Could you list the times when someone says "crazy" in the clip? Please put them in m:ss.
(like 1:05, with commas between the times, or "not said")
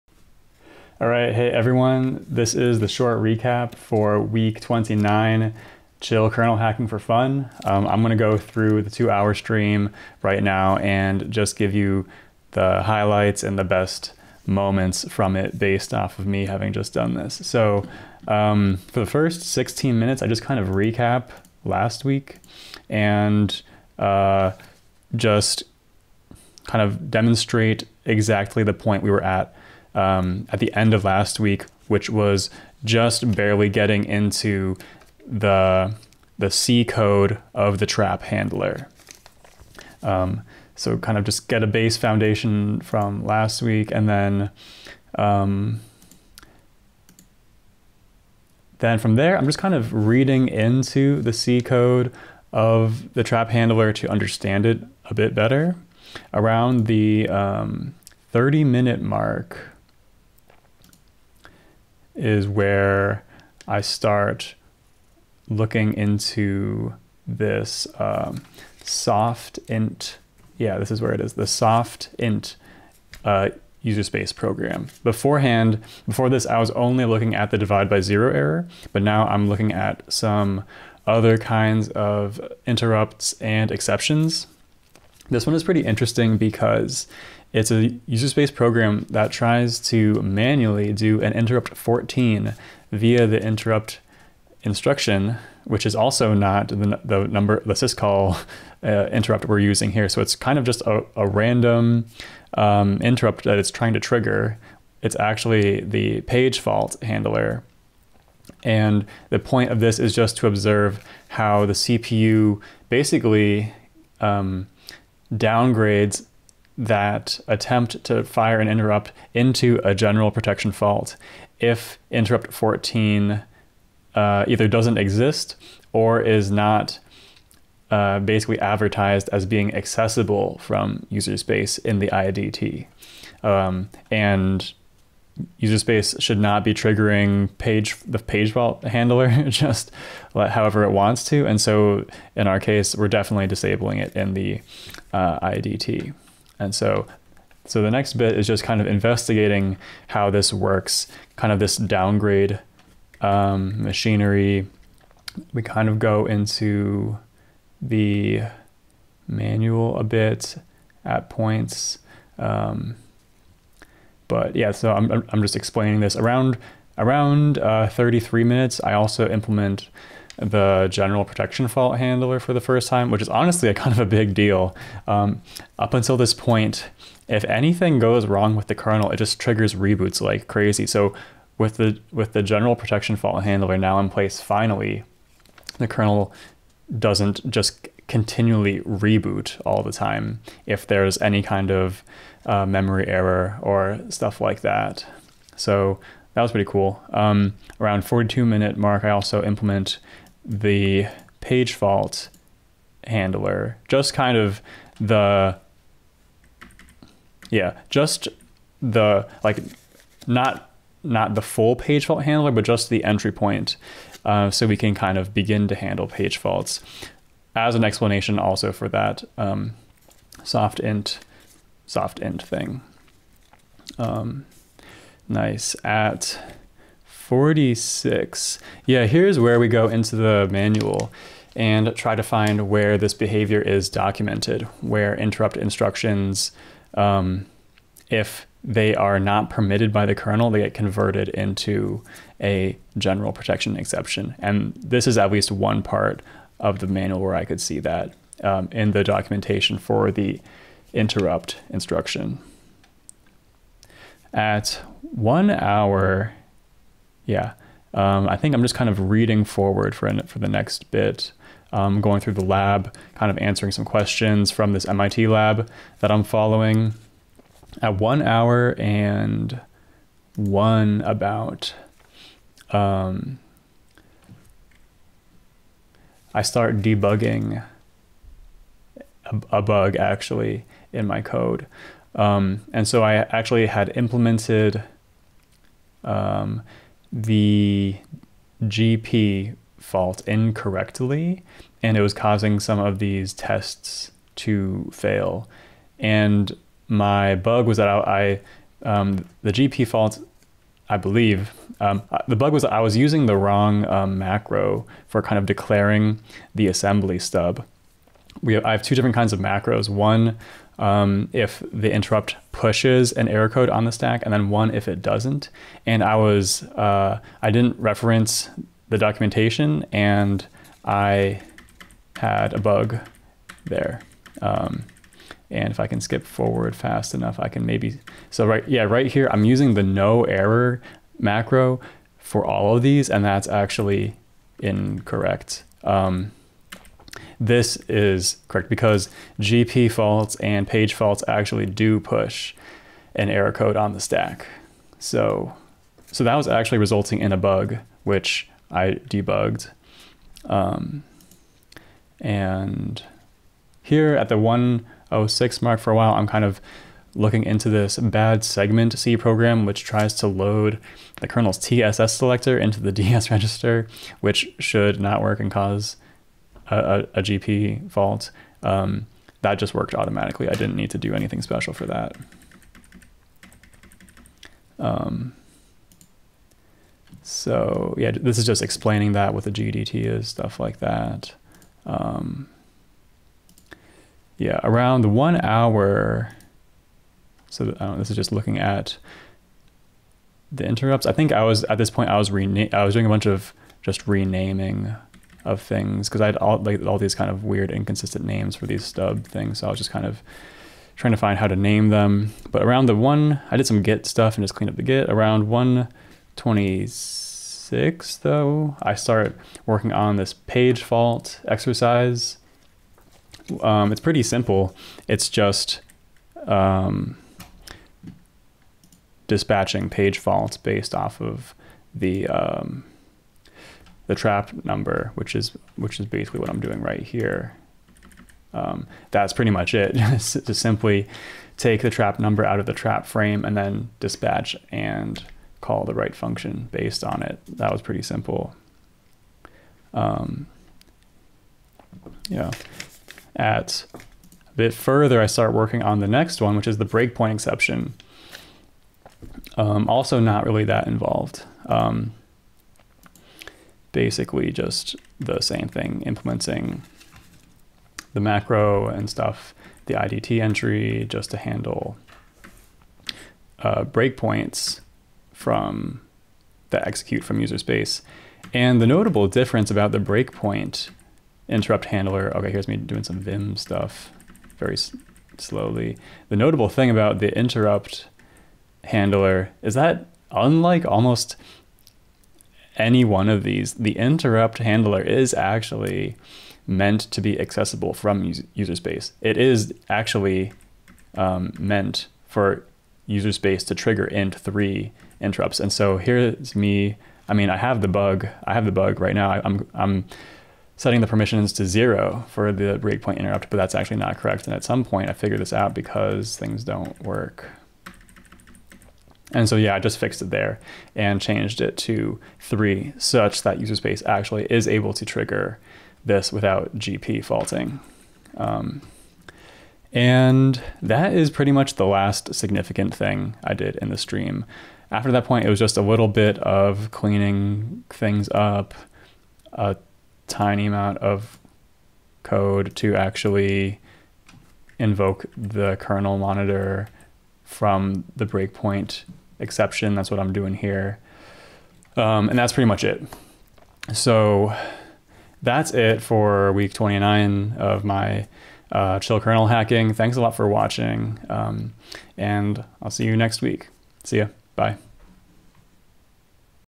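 3:00.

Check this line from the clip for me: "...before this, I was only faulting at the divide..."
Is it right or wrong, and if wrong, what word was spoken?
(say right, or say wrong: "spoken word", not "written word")
wrong: "looking", not "faulting".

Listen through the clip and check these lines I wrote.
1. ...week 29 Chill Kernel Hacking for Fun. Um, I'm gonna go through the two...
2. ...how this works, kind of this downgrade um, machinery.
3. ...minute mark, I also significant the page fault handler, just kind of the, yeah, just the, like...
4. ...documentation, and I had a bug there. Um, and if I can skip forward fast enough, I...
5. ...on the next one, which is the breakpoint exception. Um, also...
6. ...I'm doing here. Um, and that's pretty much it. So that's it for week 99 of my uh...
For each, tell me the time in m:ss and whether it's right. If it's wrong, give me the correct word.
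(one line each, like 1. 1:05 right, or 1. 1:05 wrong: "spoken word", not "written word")
1. 0:04 right
2. 2:30 right
3. 3:18 wrong: "implement", not "significant"
4. 5:18 right
5. 7:25 right
6. 9:00 wrong: "29", not "99".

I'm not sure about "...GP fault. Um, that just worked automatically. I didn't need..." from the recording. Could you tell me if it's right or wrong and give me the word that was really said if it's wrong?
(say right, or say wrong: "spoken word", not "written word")
right.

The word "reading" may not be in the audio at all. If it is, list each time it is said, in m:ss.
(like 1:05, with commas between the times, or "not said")
0:49, 4:19.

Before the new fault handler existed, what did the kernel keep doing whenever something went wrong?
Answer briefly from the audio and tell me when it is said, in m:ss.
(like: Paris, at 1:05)
reboots, at 2:59.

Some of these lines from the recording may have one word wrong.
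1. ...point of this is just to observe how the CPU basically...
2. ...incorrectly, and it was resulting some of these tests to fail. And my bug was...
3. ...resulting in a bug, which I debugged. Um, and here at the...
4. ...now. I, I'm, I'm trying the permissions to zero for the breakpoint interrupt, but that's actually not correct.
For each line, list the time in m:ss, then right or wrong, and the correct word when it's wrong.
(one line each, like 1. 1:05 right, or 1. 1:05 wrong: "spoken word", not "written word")
1. 1:49 right
2. 4:50 wrong: "causing", not "resulting"
3. 5:46 right
4. 8:19 wrong: "setting", not "trying".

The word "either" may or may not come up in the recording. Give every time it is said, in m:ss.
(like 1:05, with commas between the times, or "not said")
2:04.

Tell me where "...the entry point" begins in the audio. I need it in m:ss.
3:32.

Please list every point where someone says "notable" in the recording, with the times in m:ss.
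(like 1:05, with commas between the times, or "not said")
7:48, 7:56.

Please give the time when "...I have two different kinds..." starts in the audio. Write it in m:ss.
5:08.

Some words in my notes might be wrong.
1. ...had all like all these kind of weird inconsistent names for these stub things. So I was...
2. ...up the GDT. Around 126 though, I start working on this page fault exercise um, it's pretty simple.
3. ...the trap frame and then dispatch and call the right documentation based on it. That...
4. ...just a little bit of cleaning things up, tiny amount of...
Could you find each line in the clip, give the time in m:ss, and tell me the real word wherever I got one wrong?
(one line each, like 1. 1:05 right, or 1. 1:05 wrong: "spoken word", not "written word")
1. 6:36 right
2. 6:44 wrong: "Git", not "GDT"
3. 7:12 wrong: "function", not "documentation"
4. 8:45 right.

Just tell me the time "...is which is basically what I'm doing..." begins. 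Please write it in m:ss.
7:05.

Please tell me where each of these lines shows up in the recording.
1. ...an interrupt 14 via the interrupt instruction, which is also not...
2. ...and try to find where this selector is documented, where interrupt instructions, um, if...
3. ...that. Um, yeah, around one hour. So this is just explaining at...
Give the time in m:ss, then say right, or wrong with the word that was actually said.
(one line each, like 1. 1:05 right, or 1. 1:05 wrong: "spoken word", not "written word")
1. 1:31 right
2. 3:51 wrong: "behavior", not "selector"
3. 6:20 wrong: "looking", not "explaining".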